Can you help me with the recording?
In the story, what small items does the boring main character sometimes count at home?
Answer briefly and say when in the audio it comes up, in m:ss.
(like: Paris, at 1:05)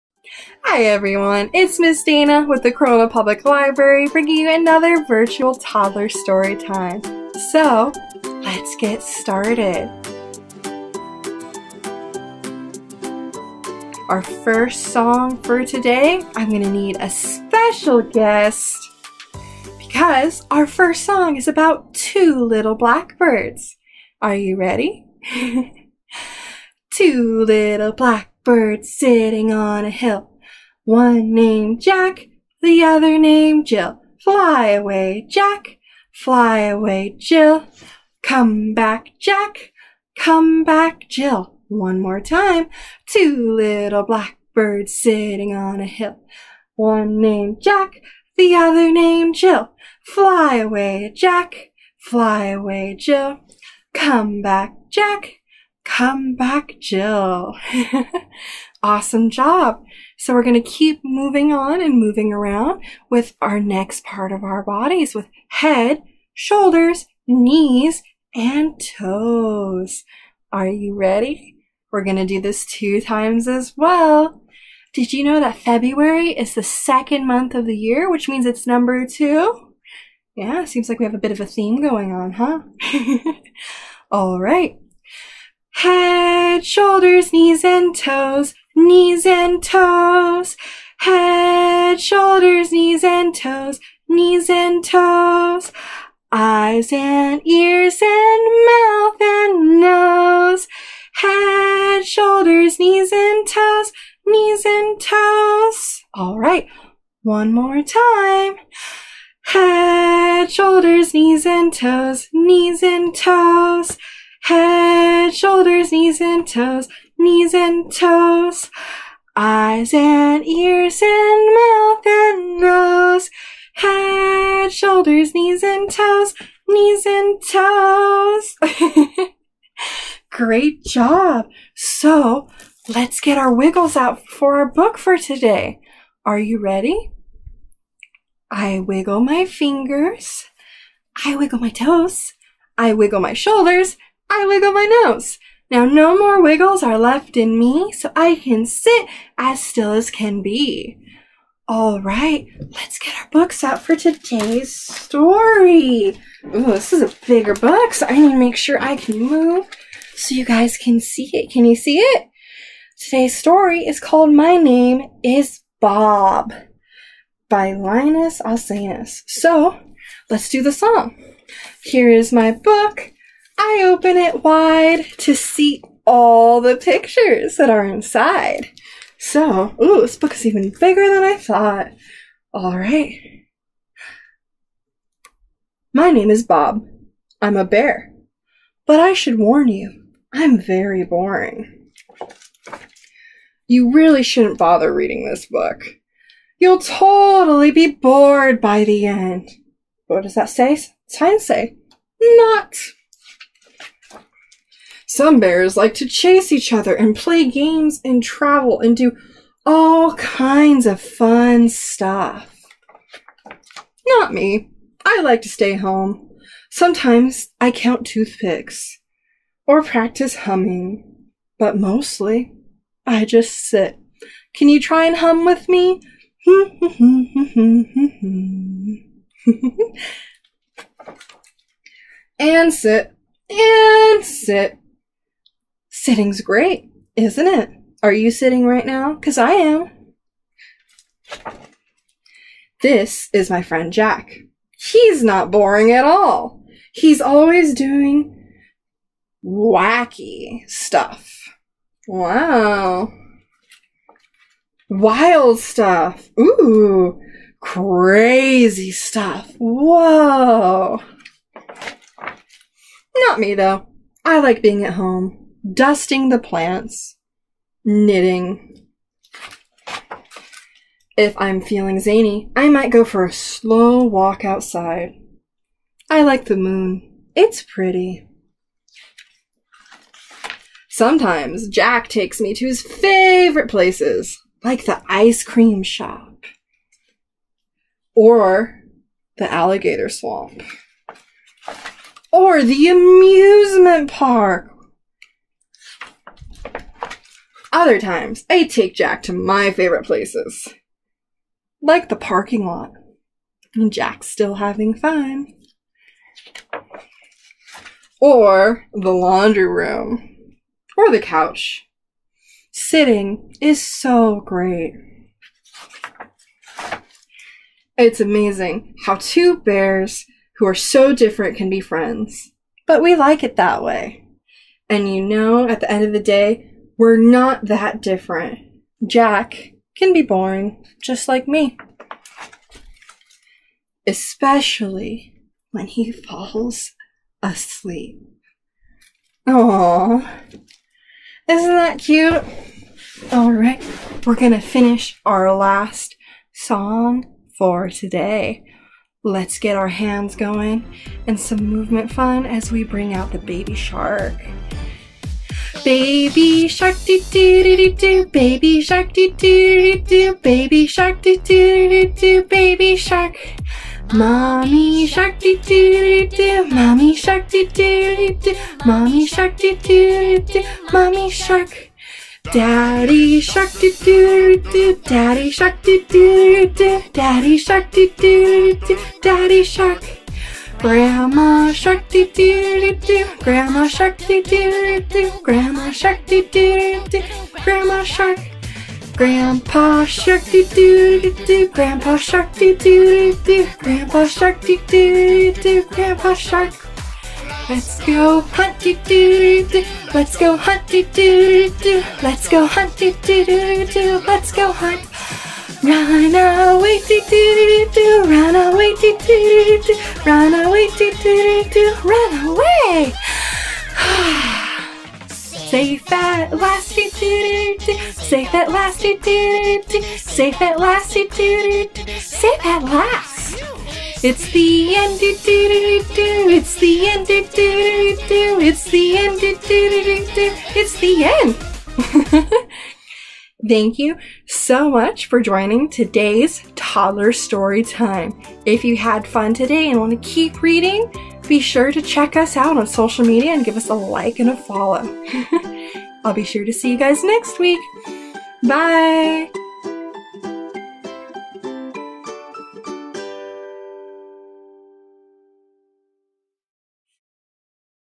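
Toothpicks, at 3:38.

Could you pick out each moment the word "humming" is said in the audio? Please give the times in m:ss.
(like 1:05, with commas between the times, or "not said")
3:40.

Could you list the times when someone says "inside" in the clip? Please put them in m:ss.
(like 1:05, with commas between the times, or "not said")
2:57.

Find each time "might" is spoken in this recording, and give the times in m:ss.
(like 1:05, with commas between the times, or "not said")
4:32.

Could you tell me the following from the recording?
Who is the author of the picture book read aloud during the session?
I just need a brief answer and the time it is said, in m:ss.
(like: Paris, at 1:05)
Linas Alsenas, at 2:47.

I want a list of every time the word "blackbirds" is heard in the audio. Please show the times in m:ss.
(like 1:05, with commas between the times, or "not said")
0:22, 0:27, 0:44.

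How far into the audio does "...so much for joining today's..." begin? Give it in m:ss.
7:14.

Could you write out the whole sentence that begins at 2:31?
All right, let's get our books out for today's story.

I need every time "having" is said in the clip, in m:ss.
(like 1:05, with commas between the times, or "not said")
5:04.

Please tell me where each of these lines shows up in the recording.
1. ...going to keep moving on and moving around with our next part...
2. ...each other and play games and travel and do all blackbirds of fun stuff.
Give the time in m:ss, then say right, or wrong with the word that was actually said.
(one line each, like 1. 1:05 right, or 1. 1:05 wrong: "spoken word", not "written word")
1. 1:00 right
2. 3:26 wrong: "kinds", not "blackbirds".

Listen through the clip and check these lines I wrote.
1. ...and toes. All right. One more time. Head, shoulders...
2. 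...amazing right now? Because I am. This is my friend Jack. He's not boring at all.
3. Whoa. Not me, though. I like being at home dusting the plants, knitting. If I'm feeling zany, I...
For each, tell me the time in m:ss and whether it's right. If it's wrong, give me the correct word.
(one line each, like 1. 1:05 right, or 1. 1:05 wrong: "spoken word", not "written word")
1. 1:44 right
2. 3:58 wrong: "sitting", not "amazing"
3. 4:19 right.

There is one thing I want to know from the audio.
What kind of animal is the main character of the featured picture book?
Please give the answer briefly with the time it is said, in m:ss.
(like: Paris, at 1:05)
A bear, at 3:07.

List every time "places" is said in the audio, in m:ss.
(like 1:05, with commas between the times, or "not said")
4:43, 5:00.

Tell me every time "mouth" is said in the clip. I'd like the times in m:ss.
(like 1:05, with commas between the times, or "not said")
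1:38, 2:01.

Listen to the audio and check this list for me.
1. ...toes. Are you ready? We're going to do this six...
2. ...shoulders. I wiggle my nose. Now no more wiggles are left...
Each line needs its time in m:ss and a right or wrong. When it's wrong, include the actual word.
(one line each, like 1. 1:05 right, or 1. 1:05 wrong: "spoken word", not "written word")
1. 1:08 wrong: "two", not "six"
2. 2:23 right.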